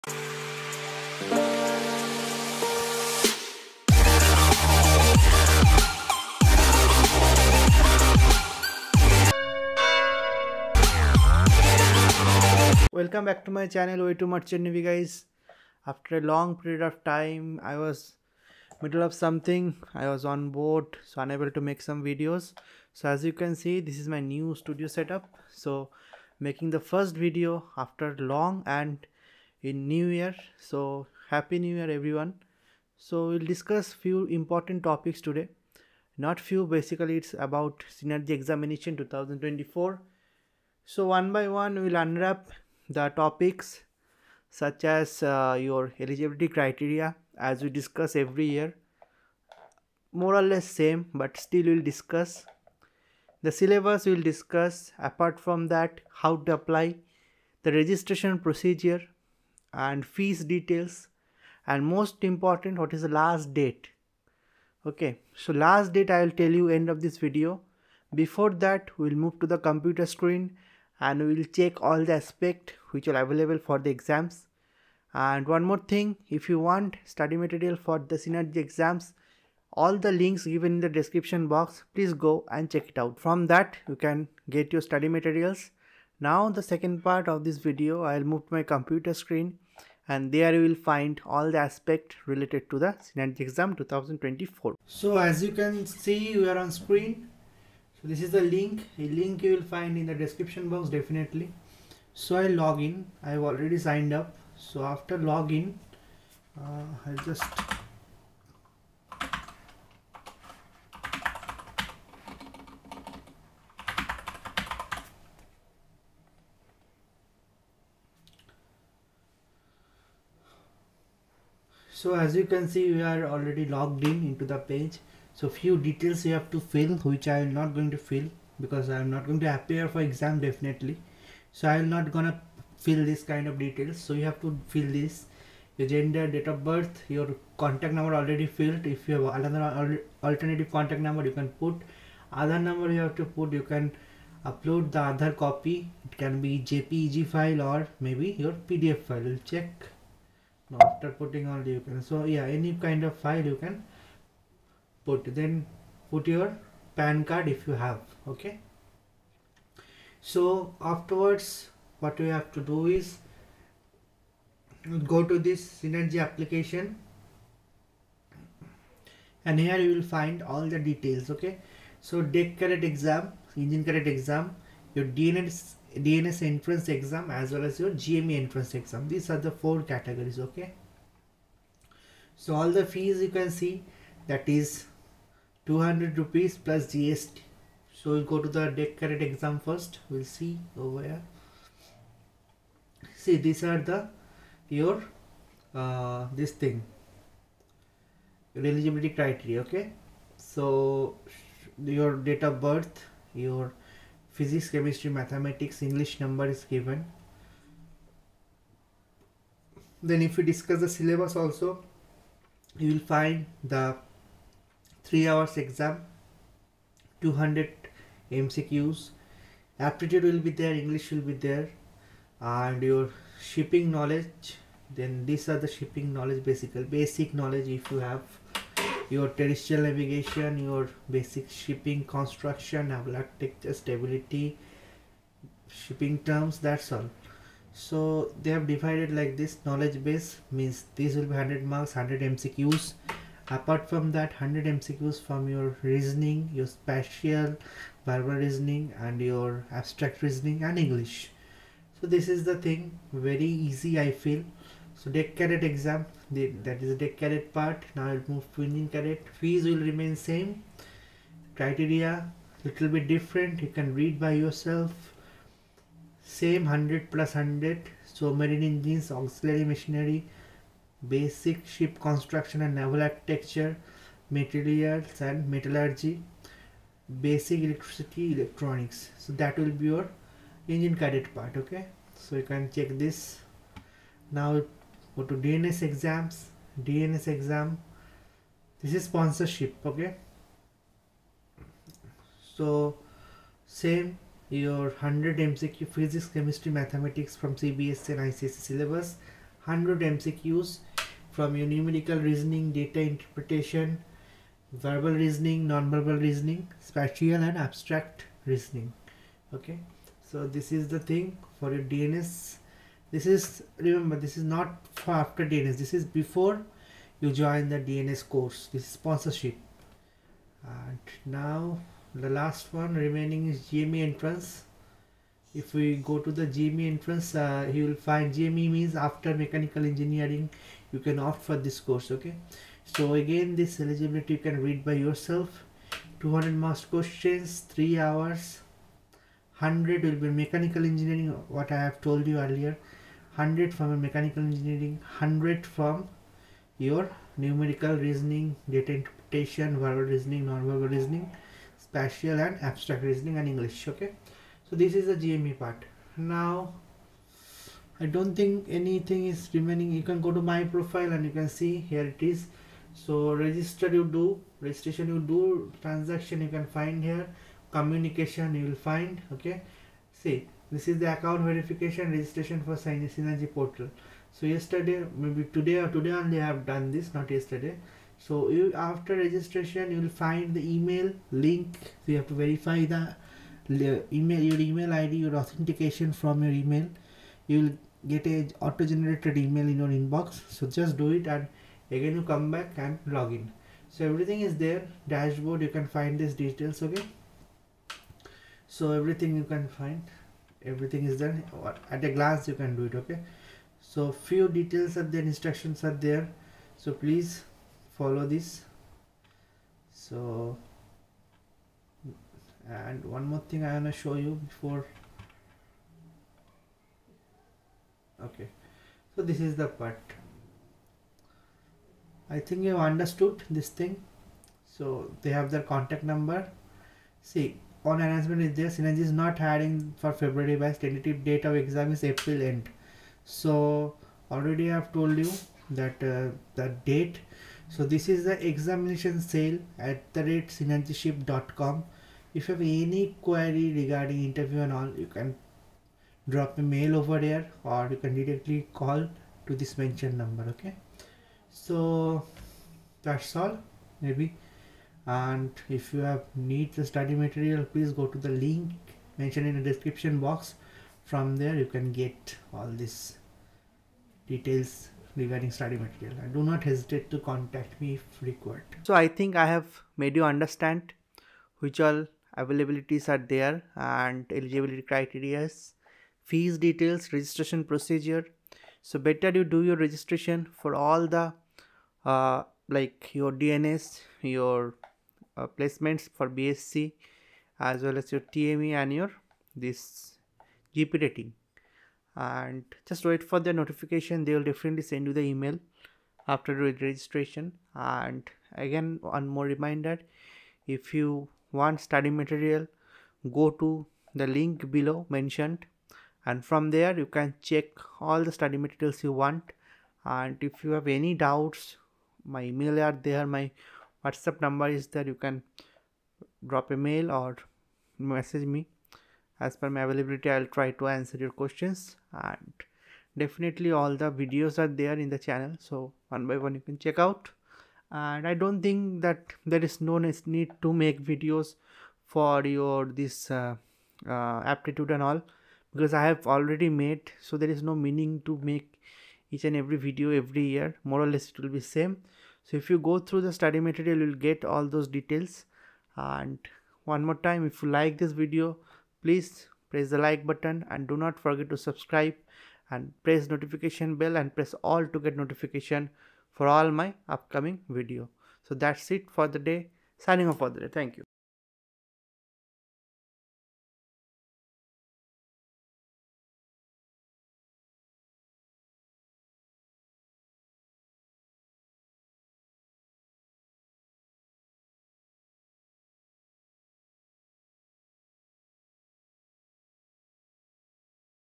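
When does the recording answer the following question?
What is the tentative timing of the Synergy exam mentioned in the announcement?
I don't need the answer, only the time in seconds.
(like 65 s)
432 s.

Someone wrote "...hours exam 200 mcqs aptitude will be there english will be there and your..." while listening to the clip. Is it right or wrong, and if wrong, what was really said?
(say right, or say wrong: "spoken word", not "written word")
right.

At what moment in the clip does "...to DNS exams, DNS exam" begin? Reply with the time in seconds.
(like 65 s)
285 s.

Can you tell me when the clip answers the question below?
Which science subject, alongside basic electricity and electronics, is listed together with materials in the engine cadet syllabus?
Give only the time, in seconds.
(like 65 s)
275 s.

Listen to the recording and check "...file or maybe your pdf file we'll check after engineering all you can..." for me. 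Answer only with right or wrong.
wrong.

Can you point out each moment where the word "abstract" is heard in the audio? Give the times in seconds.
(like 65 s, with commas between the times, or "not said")
249 s, 307 s, 352 s.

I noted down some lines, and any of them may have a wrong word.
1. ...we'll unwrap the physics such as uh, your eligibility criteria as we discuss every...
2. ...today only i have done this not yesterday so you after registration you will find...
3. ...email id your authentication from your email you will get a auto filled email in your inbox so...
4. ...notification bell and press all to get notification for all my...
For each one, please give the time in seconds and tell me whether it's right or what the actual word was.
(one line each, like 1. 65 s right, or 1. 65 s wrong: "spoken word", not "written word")
1. 41 s wrong: "topics", not "physics"
2. 375 s right
3. 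384 s wrong: "generated", not "filled"
4. 553 s right.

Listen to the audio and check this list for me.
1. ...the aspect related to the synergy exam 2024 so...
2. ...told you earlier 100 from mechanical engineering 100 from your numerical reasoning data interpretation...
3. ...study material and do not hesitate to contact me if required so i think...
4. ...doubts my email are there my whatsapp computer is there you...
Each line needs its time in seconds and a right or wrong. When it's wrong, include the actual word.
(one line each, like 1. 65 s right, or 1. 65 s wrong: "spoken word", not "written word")
1. 91 s right
2. 342 s right
3. 465 s right
4. 511 s wrong: "number", not "computer".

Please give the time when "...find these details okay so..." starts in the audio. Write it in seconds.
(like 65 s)
395 s.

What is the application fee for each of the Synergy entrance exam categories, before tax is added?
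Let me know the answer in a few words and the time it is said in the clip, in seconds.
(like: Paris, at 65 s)
200 rupees, at 185 s.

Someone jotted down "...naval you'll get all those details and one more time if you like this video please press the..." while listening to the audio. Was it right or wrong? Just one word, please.
wrong.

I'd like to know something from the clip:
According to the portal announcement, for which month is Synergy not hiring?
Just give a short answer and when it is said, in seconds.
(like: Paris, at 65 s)
February, at 430 s.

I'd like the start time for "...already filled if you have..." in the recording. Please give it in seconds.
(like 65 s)
138 s.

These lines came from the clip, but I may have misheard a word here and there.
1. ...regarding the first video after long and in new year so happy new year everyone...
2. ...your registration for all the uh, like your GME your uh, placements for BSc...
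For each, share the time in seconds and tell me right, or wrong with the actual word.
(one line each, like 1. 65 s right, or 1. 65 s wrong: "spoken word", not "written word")
1. 26 s wrong: "making", not "regarding"
2. 479 s wrong: "DNS", not "GME".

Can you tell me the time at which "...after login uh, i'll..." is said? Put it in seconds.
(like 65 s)
104 s.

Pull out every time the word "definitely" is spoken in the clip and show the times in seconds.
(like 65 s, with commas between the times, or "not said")
100 s, 130 s, 494 s, 523 s.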